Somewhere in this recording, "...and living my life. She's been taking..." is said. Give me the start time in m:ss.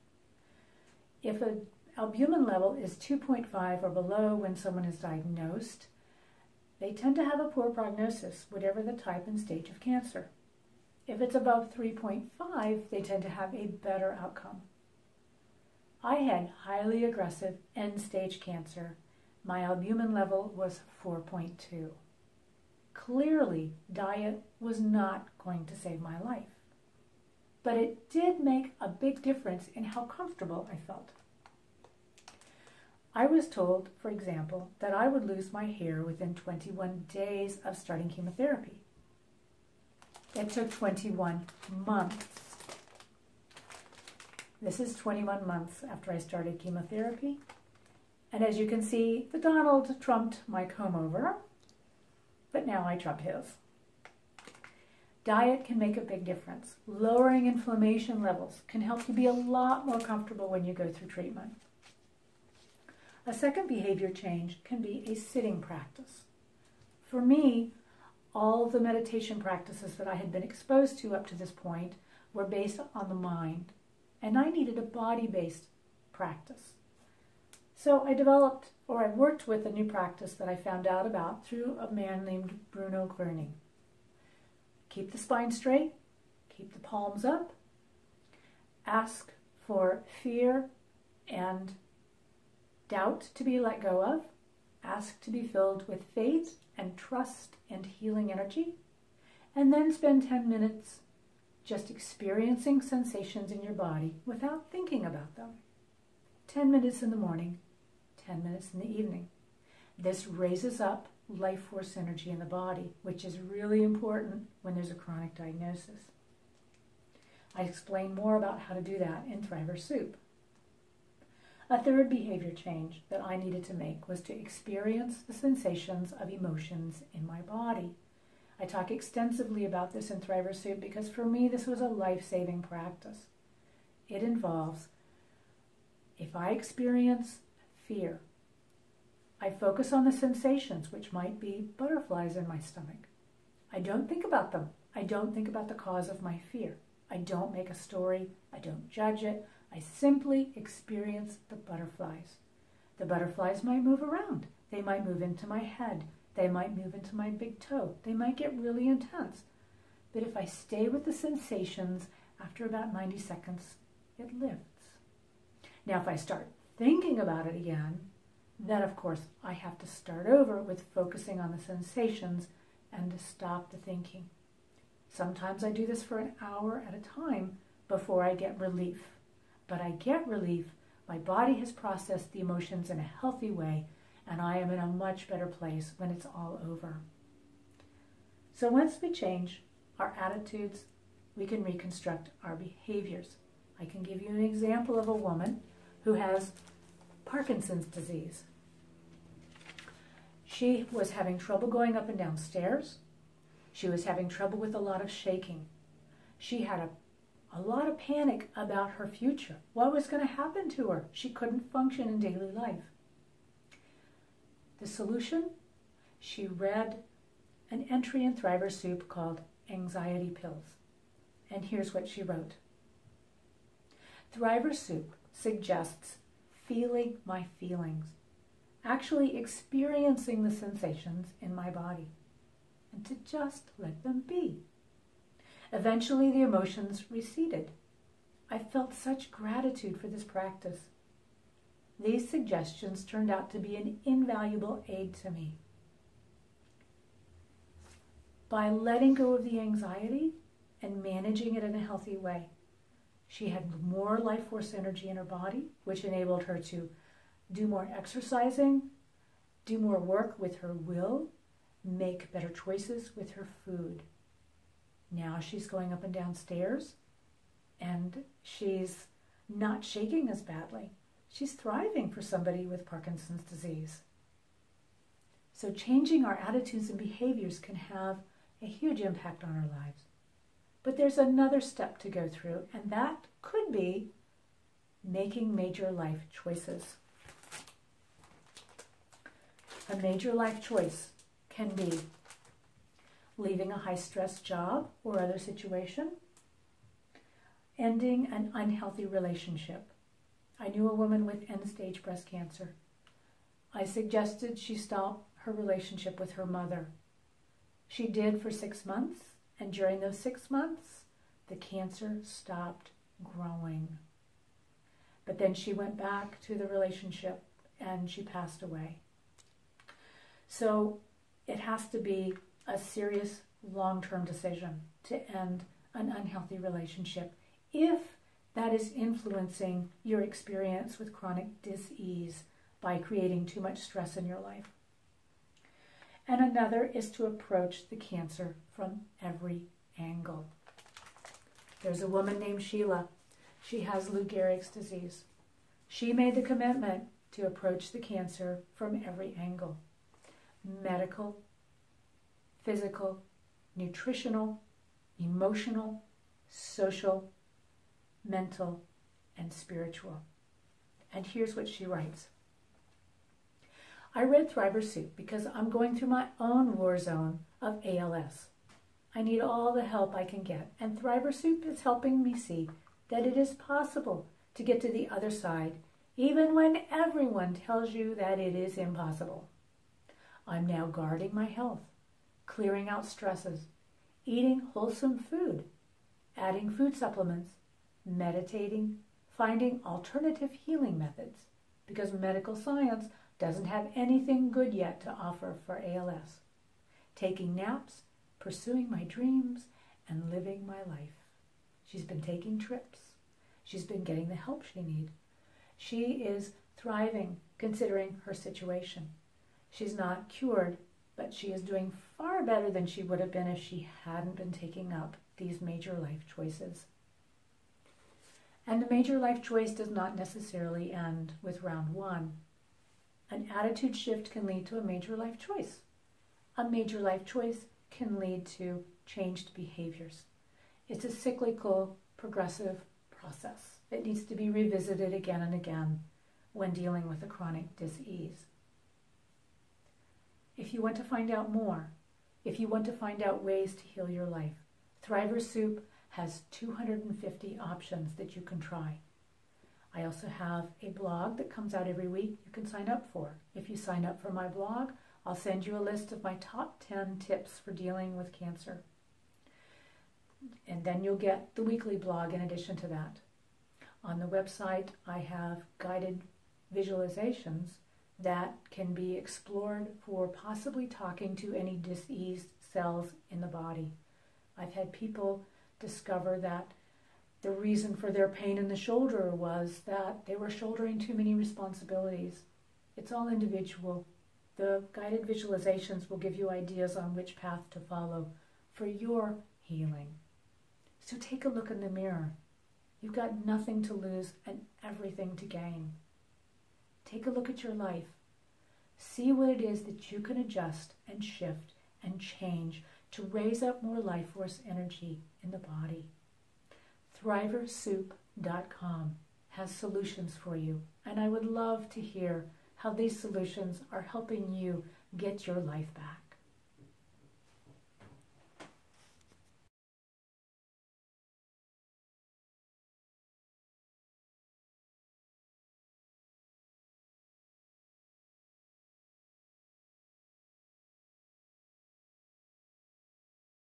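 6:40.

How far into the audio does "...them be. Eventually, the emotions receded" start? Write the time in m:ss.
3:54.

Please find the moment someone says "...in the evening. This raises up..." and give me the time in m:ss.
1:48.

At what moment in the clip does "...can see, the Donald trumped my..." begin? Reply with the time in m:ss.
0:48.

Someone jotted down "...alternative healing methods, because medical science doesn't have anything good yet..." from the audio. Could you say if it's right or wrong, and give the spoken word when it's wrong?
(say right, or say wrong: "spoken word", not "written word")
right.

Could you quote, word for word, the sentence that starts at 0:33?
I was told, for example, that I would lose my hair within 21 days of starting chemotherapy.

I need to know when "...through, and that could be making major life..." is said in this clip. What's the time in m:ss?
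4:42.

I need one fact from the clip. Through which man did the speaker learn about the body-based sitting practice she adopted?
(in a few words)
Bruno Gröning.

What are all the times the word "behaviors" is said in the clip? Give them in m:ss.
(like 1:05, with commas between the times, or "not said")
1:03, 2:02, 3:12, 4:36, 7:09.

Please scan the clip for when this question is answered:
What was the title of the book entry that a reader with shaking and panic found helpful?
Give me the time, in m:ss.
3:39.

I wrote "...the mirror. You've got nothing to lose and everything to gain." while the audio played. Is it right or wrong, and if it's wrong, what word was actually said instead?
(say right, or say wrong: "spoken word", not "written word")
right.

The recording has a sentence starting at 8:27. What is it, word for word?
Thriversoup.com has solutions for you, and I would love to hear how these solutions are helping you get your life back.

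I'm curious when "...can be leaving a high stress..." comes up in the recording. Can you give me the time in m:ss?
4:51.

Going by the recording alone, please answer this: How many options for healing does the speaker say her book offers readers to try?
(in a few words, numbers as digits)
250.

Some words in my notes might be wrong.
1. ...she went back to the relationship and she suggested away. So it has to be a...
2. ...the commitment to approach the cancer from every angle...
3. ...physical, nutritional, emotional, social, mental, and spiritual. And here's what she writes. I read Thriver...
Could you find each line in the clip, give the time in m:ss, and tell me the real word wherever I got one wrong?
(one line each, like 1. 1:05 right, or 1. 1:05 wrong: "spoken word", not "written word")
1. 5:15 wrong: "passed", not "suggested"
2. 5:46 right
3. 5:52 right.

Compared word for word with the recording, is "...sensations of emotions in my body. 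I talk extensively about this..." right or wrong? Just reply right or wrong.
right.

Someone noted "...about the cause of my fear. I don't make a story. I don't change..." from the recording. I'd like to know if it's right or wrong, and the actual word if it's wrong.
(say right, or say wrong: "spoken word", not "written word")
wrong: "judge", not "change".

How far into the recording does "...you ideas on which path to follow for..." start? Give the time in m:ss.
8:06.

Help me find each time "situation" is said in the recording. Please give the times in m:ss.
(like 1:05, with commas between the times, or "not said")
4:55, 6:48.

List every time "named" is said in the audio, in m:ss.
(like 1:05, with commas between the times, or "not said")
1:22, 5:42.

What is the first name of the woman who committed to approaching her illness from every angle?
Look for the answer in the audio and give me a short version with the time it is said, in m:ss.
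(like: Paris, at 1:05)
Sheila, at 5:42.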